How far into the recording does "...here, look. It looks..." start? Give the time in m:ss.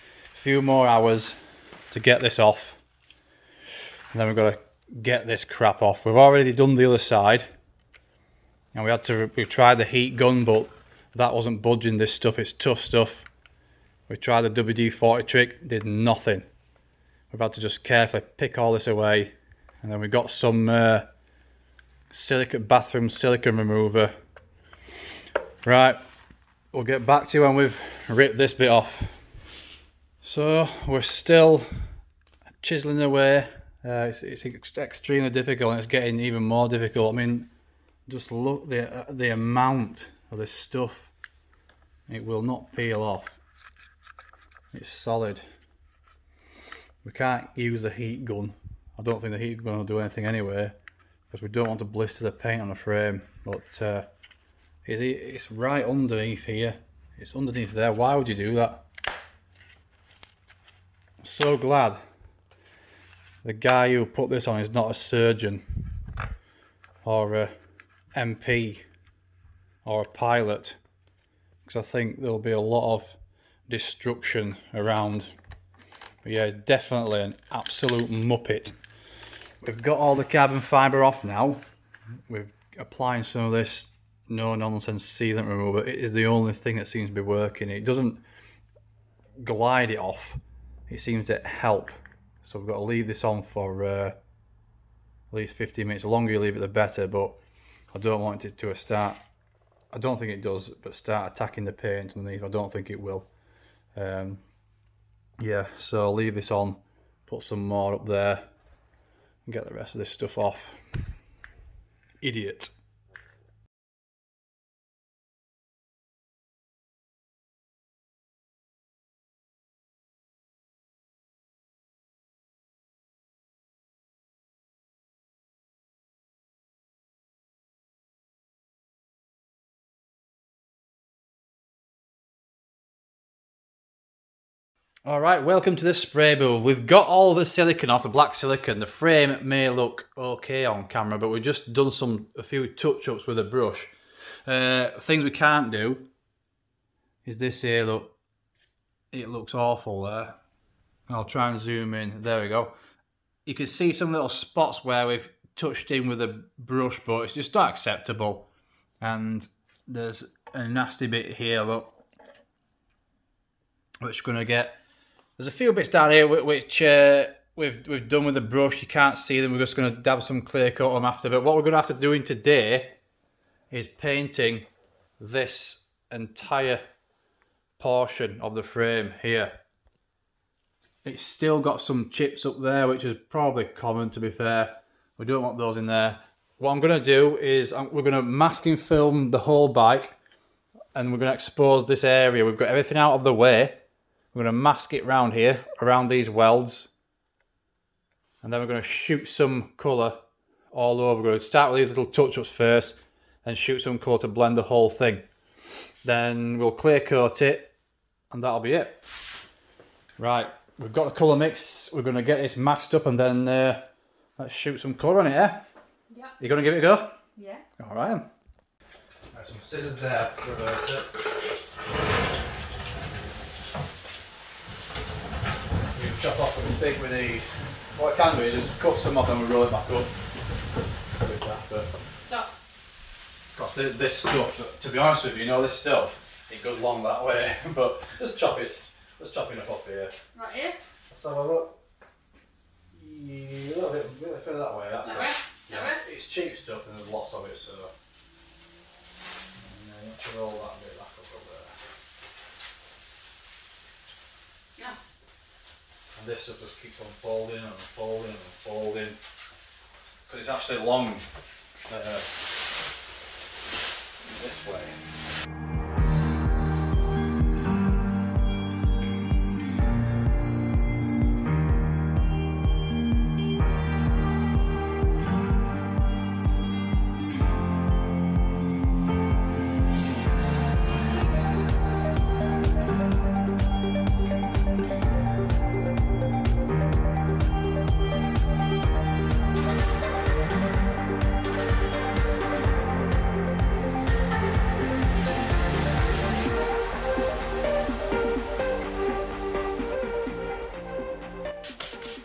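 2:27.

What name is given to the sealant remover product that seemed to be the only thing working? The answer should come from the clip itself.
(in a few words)
no-nonsense.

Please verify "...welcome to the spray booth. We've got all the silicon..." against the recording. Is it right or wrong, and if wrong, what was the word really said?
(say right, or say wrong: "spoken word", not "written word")
right.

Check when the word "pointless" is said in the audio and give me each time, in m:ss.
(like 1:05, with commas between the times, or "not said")
not said.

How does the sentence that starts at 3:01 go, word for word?
It's still got some chips up there, which is probably common to be fair.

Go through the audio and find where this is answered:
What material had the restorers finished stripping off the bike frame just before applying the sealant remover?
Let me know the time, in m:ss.
1:20.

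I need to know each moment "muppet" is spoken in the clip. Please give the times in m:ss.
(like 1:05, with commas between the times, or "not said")
1:18.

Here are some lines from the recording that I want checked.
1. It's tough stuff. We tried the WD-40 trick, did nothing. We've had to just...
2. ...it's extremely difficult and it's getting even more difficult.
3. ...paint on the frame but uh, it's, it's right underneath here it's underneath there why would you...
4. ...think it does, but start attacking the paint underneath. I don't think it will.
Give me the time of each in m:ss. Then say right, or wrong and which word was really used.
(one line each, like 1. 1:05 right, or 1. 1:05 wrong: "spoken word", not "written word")
1. 0:12 right
2. 0:34 right
3. 0:52 right
4. 1:40 right.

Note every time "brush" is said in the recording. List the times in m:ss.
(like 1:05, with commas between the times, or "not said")
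2:23, 2:36, 2:48.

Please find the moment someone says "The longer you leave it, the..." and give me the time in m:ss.
1:36.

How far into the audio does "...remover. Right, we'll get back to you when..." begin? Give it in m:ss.
0:23.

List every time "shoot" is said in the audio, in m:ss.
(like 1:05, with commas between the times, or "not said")
3:18, 3:23, 3:34.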